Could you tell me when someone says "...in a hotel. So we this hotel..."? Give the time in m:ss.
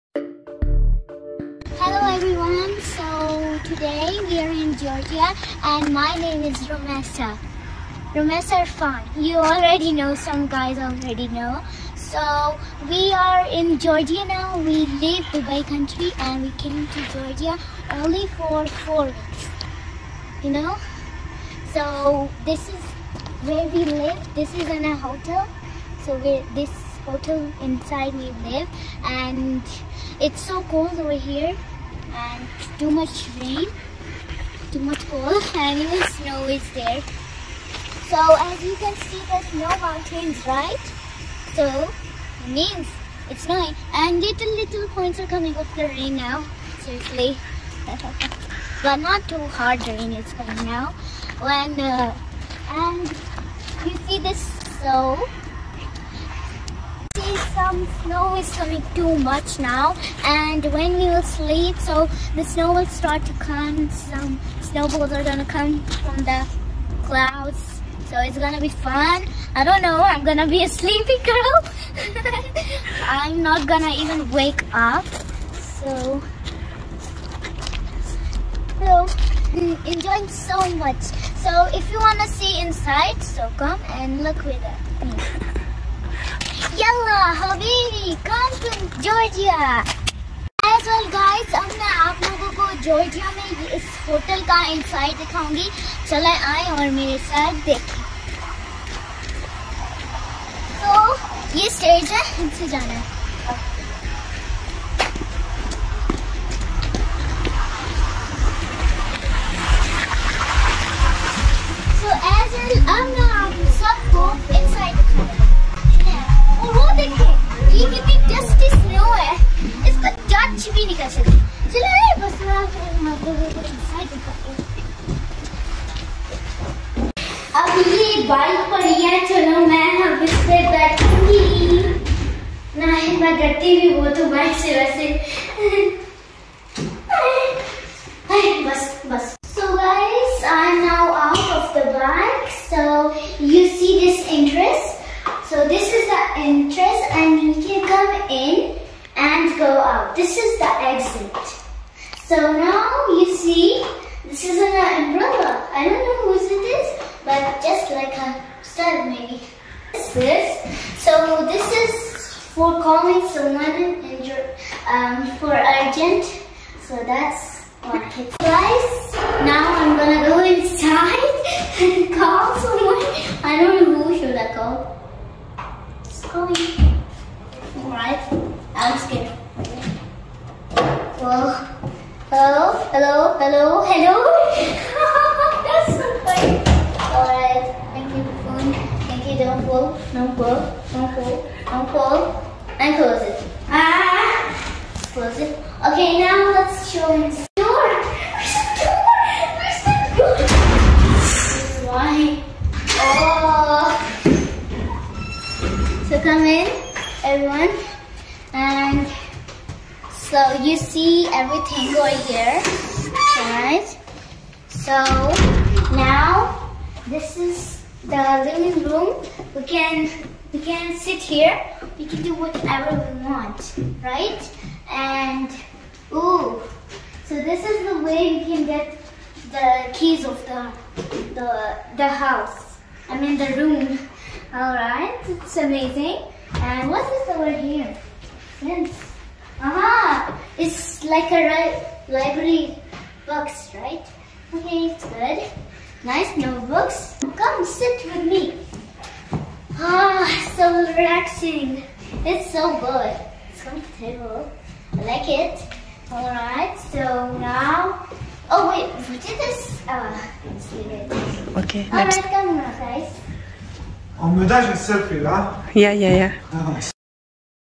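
0:24.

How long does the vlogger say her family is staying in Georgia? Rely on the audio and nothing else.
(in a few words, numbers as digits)
4 weeks.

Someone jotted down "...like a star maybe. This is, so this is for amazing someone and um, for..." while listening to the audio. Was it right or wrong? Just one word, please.
wrong.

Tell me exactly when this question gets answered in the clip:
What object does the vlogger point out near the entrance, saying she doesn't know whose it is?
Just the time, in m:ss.
2:34.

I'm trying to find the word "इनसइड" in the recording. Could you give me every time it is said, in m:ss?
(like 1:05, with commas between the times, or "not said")
1:34.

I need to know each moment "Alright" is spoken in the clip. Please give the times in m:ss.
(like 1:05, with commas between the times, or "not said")
2:57, 3:33, 4:16, 4:21.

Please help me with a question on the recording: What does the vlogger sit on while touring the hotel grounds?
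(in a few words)
Bike.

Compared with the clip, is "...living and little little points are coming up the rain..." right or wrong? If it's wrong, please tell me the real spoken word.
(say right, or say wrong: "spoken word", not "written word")
wrong: "snowing", not "living".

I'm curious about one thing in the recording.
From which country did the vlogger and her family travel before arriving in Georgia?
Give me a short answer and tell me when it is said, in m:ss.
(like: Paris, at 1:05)
Dubai, at 0:15.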